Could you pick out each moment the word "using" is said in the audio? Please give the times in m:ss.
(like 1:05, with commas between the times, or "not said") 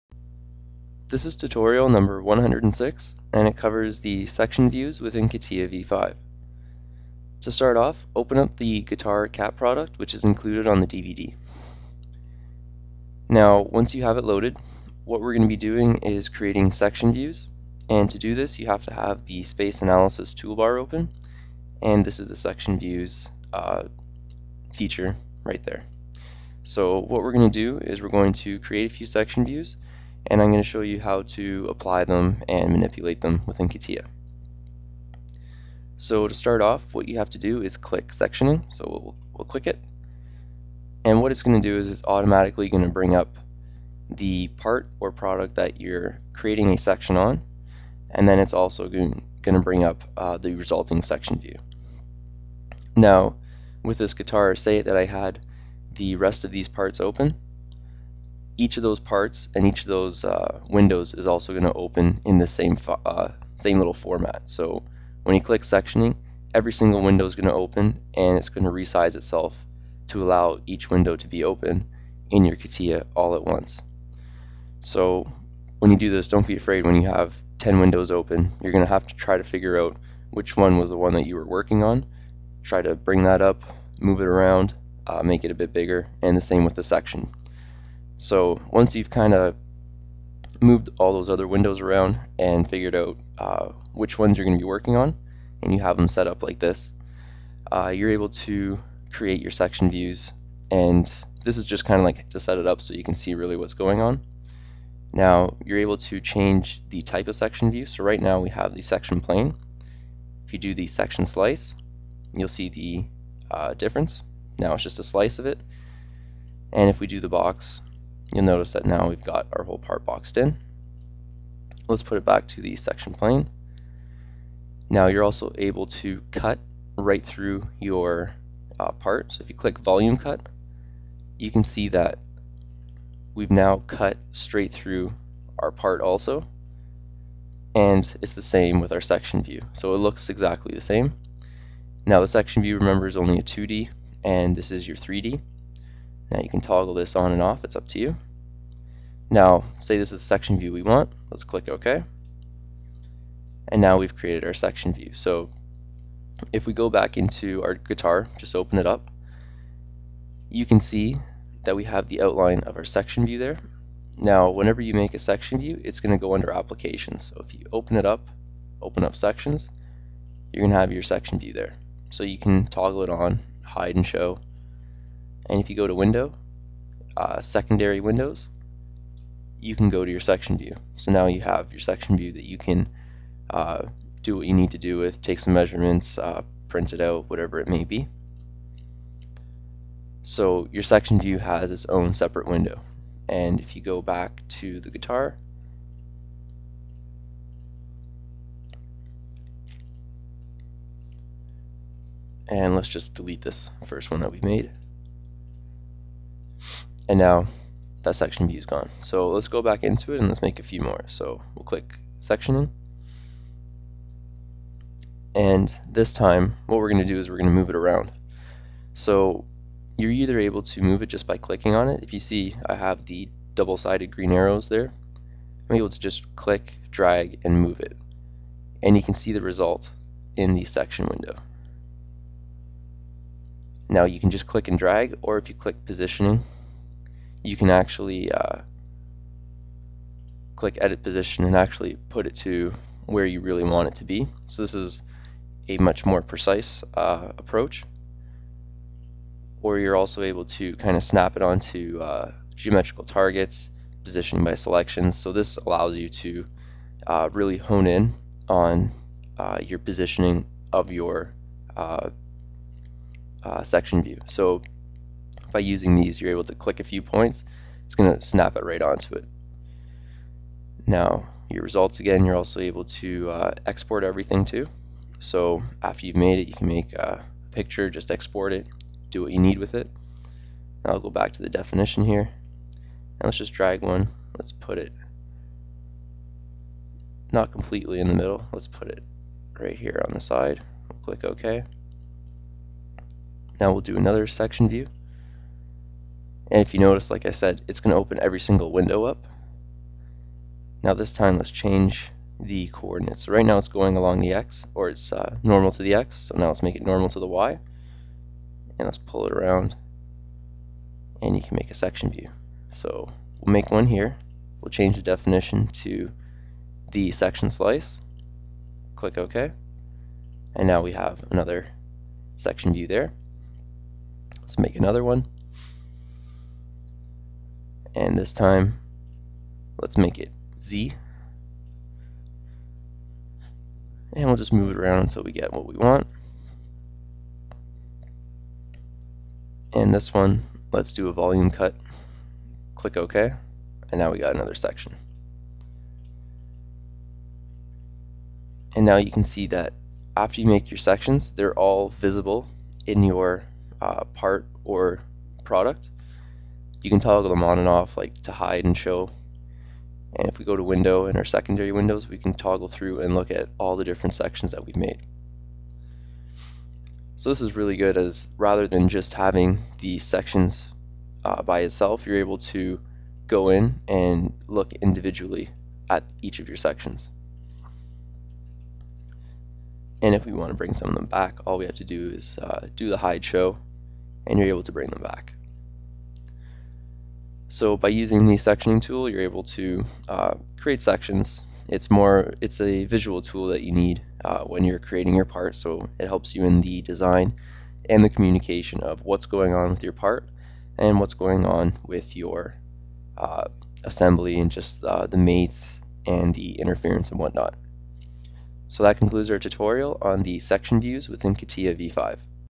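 4:25, 6:27.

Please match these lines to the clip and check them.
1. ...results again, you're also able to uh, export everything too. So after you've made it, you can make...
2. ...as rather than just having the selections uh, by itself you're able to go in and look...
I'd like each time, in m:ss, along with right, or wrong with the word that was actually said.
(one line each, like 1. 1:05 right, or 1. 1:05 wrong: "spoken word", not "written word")
1. 4:31 right
2. 6:07 wrong: "sections", not "selections".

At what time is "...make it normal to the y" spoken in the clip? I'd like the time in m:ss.
5:06.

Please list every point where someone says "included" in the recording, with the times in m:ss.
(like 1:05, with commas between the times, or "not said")
0:10.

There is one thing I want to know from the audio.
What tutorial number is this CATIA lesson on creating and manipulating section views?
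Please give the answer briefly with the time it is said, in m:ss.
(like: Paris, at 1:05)
106, at 0:02.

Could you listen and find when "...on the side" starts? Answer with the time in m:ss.
4:50.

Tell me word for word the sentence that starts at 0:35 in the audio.
So to start off, what you have to do is click sectioning.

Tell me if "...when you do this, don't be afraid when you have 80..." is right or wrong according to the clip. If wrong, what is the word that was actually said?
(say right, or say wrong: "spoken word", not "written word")
wrong: "10", not "80".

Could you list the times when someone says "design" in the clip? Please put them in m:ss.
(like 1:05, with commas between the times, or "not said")
6:36.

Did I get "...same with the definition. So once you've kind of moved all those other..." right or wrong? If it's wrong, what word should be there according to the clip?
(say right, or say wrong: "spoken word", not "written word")
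wrong: "section", not "definition".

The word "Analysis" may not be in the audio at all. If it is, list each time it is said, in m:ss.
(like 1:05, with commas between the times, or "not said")
0:19.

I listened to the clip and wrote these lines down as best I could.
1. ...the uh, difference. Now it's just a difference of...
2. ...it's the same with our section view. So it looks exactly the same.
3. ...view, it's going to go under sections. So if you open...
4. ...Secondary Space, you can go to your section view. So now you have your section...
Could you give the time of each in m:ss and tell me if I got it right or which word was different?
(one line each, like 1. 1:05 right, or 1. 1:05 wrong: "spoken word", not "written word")
1. 1:52 wrong: "slice", not "difference"
2. 2:18 right
3. 2:45 wrong: "applications", not "sections"
4. 2:57 wrong: "Windows", not "Space".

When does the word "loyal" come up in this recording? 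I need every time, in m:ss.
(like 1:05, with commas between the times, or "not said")
not said.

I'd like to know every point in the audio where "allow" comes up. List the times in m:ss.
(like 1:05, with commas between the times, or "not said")
1:10, 4:15.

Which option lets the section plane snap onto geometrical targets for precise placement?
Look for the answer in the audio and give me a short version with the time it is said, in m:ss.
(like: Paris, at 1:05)
Positioning by selections, at 4:14.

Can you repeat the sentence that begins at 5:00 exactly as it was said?
Now this time let's change the coordinates.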